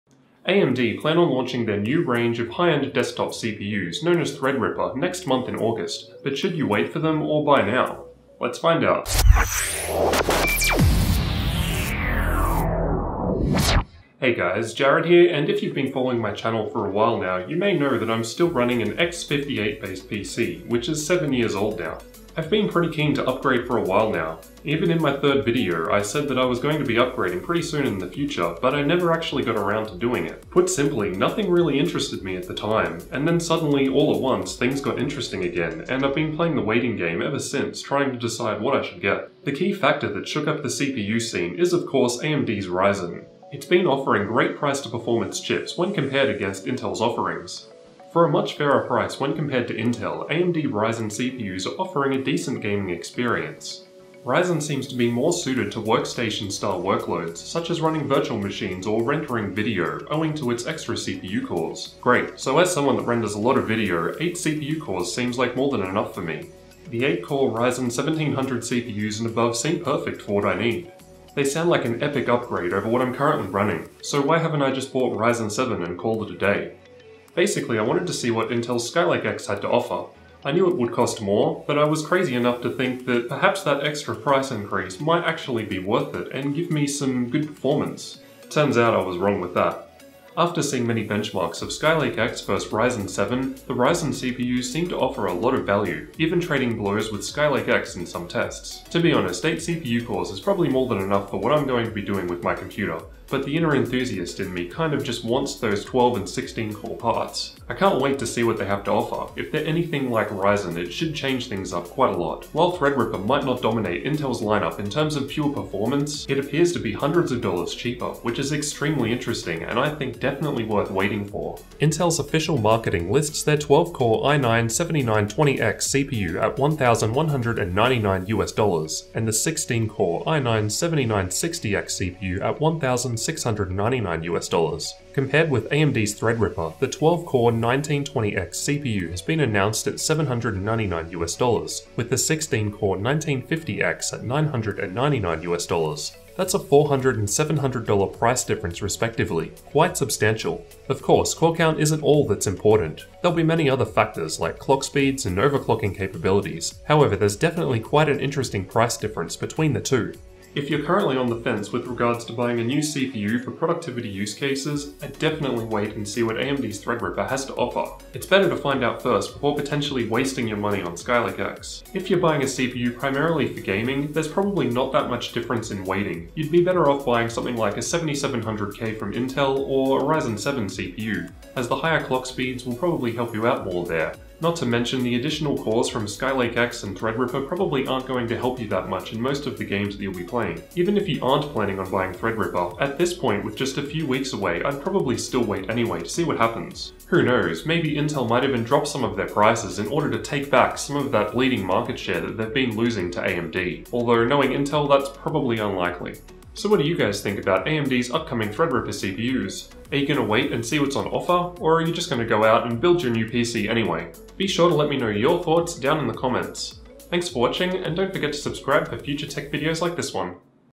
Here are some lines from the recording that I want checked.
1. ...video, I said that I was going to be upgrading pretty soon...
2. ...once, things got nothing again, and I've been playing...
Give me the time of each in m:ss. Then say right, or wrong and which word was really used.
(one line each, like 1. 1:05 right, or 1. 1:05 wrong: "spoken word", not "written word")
1. 0:25 right
2. 0:34 wrong: "interesting", not "nothing".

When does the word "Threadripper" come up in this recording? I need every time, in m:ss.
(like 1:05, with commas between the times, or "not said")
0:04, 1:52, 2:16, 2:46, 3:06, 3:12, 3:28.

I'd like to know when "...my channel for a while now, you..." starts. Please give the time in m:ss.
0:16.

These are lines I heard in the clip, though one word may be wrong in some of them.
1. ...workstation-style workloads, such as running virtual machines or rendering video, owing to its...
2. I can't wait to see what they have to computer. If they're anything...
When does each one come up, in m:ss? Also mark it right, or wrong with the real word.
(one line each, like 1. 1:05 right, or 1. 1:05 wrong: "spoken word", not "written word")
1. 0:55 right
2. 1:47 wrong: "offer", not "computer".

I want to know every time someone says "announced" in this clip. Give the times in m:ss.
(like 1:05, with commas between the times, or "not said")
2:19.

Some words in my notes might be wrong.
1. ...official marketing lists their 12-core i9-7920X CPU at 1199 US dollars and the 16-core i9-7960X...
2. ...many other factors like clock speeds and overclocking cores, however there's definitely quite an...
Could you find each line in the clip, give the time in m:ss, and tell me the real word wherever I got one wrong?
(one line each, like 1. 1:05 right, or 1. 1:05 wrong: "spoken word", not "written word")
1. 2:02 right
2. 2:33 wrong: "capabilities", not "cores".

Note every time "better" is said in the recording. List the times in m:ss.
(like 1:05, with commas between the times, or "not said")
2:48, 2:56.